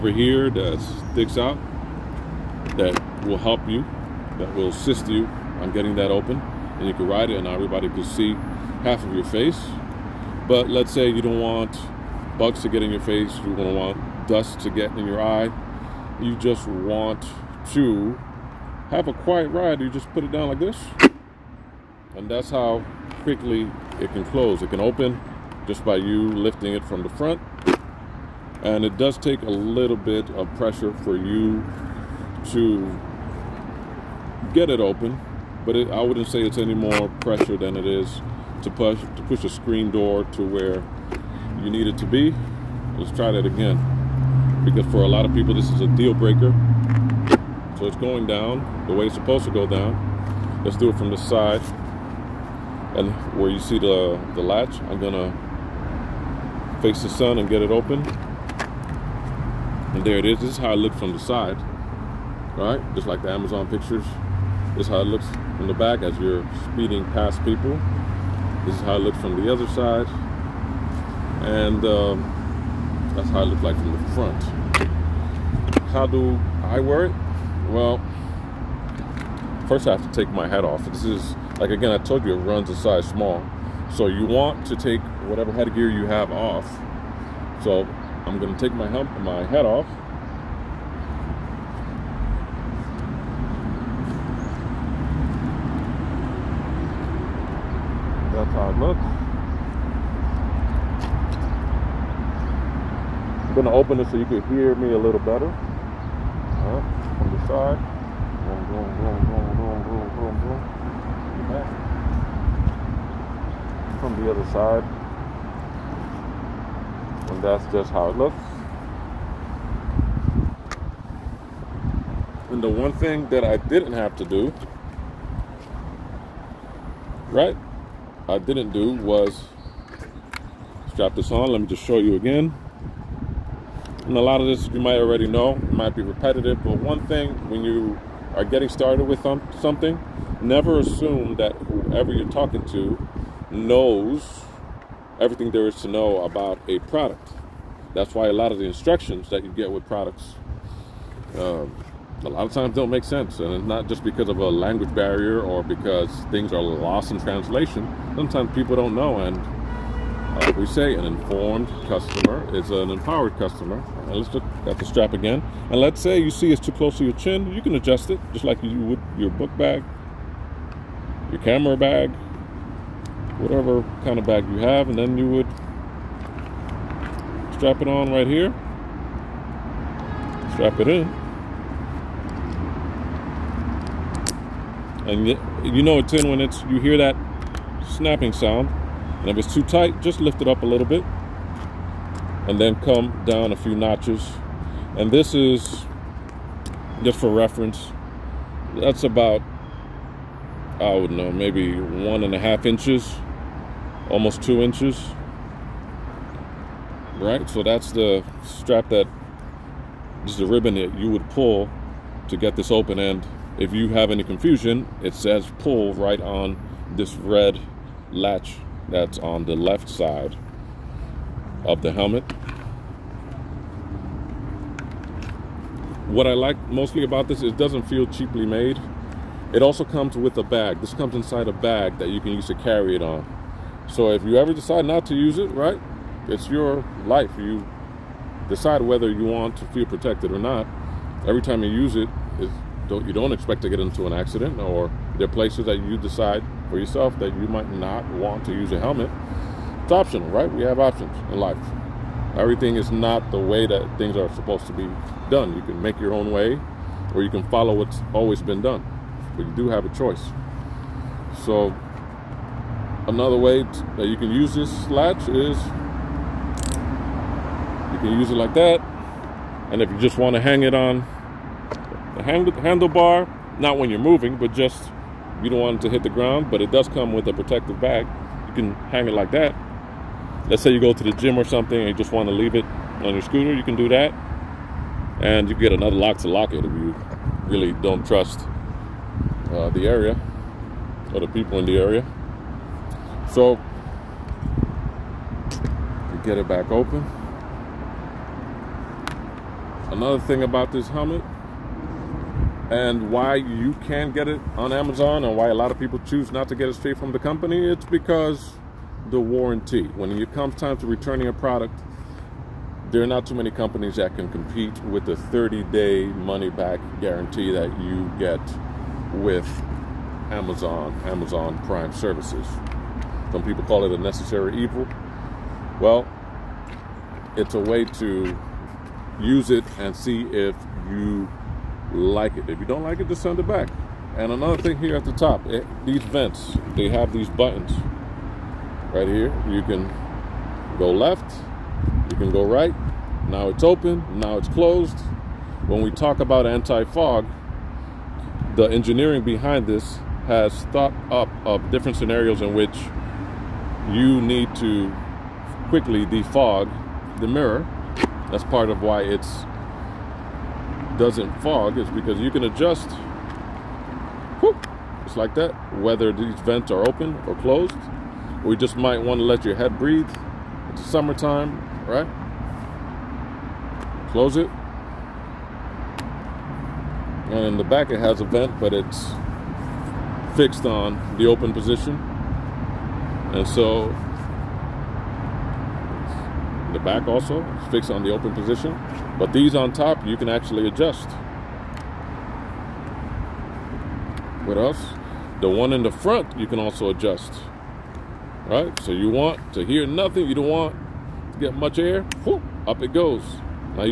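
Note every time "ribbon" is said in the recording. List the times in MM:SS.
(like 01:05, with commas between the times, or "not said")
03:30.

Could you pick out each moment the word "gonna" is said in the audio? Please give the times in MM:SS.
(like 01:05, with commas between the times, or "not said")
00:54, 01:28, 01:43.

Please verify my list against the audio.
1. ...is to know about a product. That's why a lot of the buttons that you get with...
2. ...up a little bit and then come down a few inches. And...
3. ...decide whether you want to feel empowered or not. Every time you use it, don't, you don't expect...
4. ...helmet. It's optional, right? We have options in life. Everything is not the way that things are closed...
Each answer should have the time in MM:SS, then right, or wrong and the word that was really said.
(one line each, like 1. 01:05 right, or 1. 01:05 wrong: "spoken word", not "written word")
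1. 02:25 wrong: "instructions", not "buttons"
2. 03:10 wrong: "notches", not "inches"
3. 03:58 wrong: "protected", not "empowered"
4. 04:08 wrong: "supposed", not "closed".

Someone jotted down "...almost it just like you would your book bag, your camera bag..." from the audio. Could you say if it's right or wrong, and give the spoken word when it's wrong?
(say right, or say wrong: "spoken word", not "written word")
wrong: "adjust", not "almost".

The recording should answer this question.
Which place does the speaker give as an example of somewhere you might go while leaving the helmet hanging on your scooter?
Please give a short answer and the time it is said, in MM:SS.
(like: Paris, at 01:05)
the gym, at 04:41.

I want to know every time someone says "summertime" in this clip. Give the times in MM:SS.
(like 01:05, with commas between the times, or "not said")
06:10.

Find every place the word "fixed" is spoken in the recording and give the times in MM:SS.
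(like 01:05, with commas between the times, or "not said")
06:20, 06:27.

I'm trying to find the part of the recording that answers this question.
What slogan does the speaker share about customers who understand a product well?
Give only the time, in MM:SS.
02:40.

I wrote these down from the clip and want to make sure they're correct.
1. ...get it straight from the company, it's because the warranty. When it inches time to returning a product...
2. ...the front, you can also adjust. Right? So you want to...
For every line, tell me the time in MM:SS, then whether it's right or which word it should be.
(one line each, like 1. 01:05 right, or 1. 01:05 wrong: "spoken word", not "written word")
1. 05:06 wrong: "comes", not "inches"
2. 06:35 right.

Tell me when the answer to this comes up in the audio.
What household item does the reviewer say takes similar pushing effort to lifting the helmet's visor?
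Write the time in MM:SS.
00:39.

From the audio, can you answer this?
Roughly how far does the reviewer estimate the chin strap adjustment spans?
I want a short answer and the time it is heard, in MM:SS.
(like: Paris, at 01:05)
1.5 inches, at 03:21.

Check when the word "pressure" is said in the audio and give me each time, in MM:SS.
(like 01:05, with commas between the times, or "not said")
00:30, 00:37.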